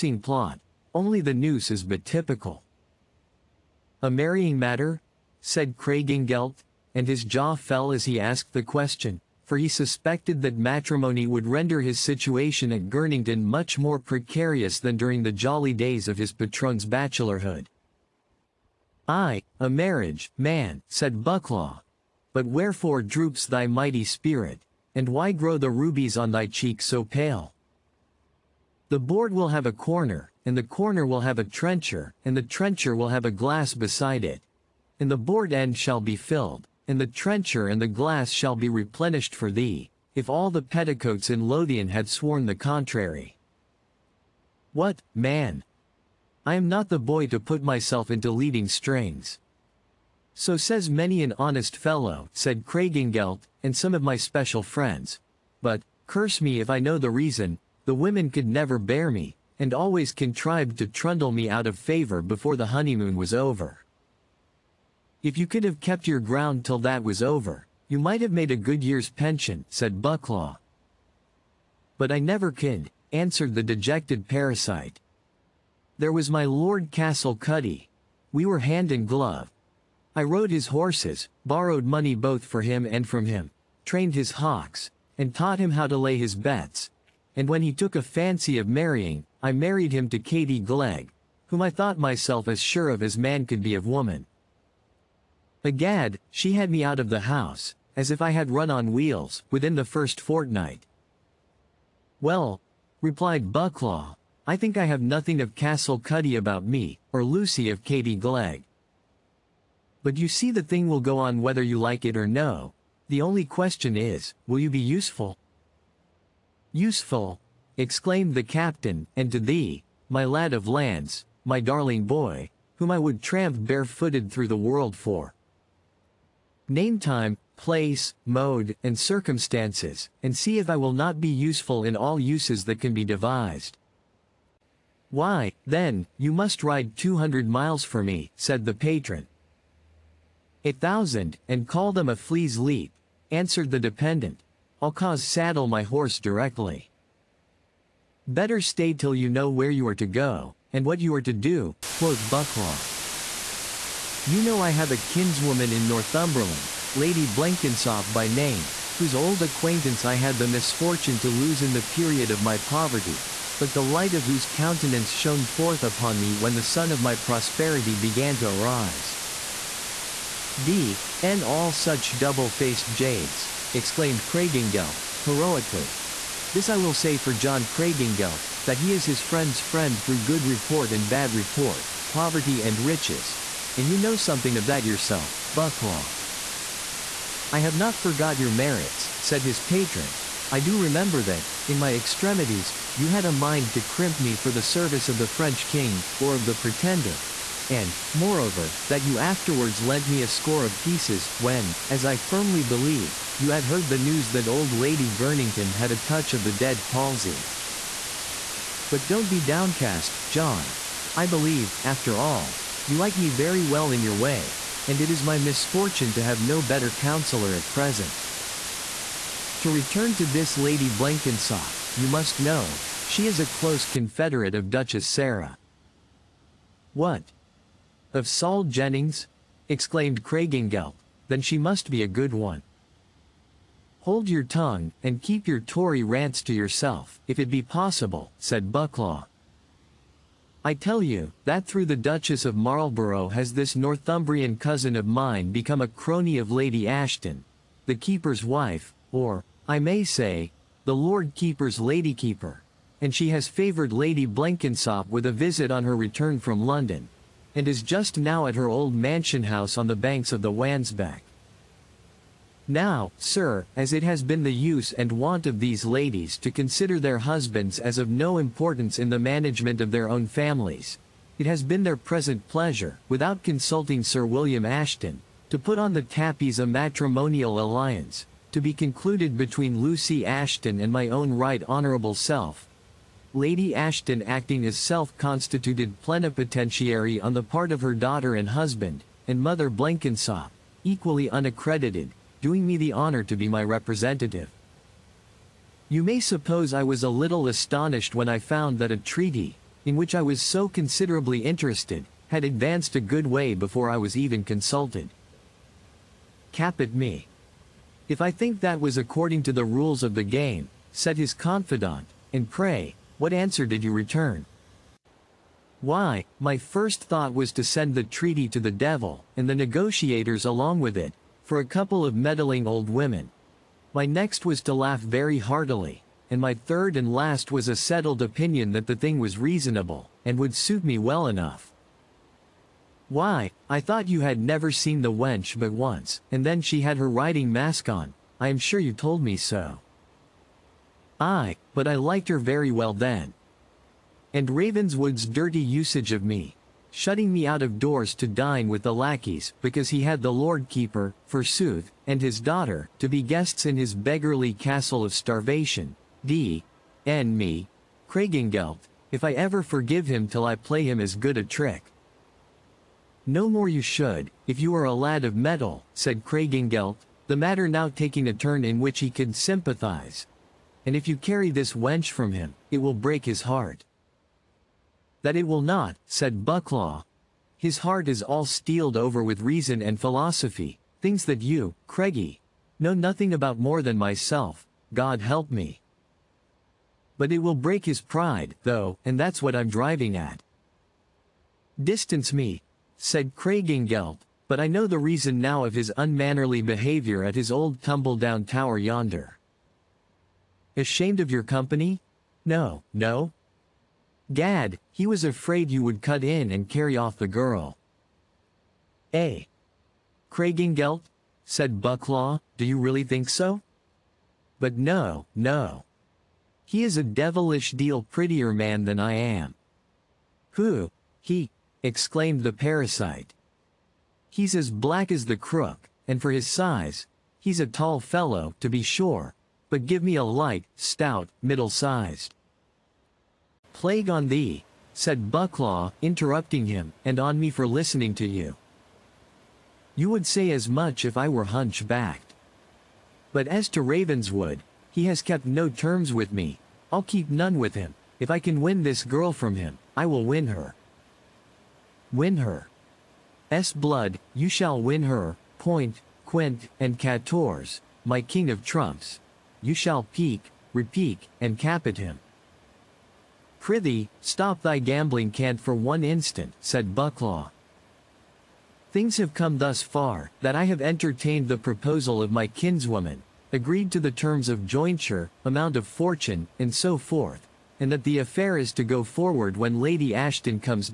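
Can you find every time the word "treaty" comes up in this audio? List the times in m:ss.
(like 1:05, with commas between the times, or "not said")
4:58, 5:18.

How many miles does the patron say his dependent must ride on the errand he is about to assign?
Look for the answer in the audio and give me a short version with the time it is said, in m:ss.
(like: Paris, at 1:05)
200, at 2:16.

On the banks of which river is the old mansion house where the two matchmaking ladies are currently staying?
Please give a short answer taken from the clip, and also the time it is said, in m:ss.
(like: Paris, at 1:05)
Wansbeck, at 4:20.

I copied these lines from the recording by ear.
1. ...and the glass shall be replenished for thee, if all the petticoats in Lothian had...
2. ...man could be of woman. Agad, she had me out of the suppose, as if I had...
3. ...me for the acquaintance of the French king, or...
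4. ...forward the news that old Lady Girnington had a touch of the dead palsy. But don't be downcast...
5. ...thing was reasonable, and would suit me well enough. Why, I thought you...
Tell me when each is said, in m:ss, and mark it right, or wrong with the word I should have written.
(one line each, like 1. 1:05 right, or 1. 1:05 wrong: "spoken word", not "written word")
1. 0:37 right
2. 1:33 wrong: "house", not "suppose"
3. 3:14 wrong: "service", not "acquaintance"
4. 3:23 wrong: "heard", not "forward"
5. 5:29 right.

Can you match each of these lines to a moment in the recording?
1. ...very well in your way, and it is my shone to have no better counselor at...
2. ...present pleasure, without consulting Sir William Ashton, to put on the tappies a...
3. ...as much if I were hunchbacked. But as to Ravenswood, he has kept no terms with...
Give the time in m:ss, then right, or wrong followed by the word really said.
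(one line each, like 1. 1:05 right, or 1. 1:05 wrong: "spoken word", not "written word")
1. 3:33 wrong: "misfortune", not "shone"
2. 4:31 right
3. 7:20 right.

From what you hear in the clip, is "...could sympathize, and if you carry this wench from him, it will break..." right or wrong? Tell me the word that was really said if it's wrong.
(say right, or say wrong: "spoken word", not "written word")
right.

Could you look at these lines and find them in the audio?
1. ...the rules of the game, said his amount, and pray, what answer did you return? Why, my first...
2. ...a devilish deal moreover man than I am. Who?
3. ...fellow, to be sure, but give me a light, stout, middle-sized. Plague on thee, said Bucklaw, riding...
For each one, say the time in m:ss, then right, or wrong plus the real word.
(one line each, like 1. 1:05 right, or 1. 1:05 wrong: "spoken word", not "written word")
1. 5:09 wrong: "confidant", not "amount"
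2. 6:56 wrong: "prettier", not "moreover"
3. 7:07 wrong: "interrupting", not "riding".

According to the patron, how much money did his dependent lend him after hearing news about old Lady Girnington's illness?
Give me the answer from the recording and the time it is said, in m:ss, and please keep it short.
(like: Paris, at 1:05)
a score of pieces, at 3:20.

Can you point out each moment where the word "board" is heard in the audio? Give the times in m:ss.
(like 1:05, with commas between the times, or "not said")
0:28, 0:35.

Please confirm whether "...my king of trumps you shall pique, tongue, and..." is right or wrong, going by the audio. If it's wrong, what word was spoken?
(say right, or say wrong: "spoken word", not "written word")
wrong: "repique", not "tongue".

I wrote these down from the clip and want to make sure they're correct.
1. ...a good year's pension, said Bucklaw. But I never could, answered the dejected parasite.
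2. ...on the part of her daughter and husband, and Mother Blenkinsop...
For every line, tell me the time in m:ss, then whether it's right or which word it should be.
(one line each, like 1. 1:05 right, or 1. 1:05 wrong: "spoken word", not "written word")
1. 1:08 right
2. 4:47 right.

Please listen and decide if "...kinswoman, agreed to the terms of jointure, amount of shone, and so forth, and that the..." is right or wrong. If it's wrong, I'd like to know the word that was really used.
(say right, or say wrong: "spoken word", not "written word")
wrong: "fortune", not "shone".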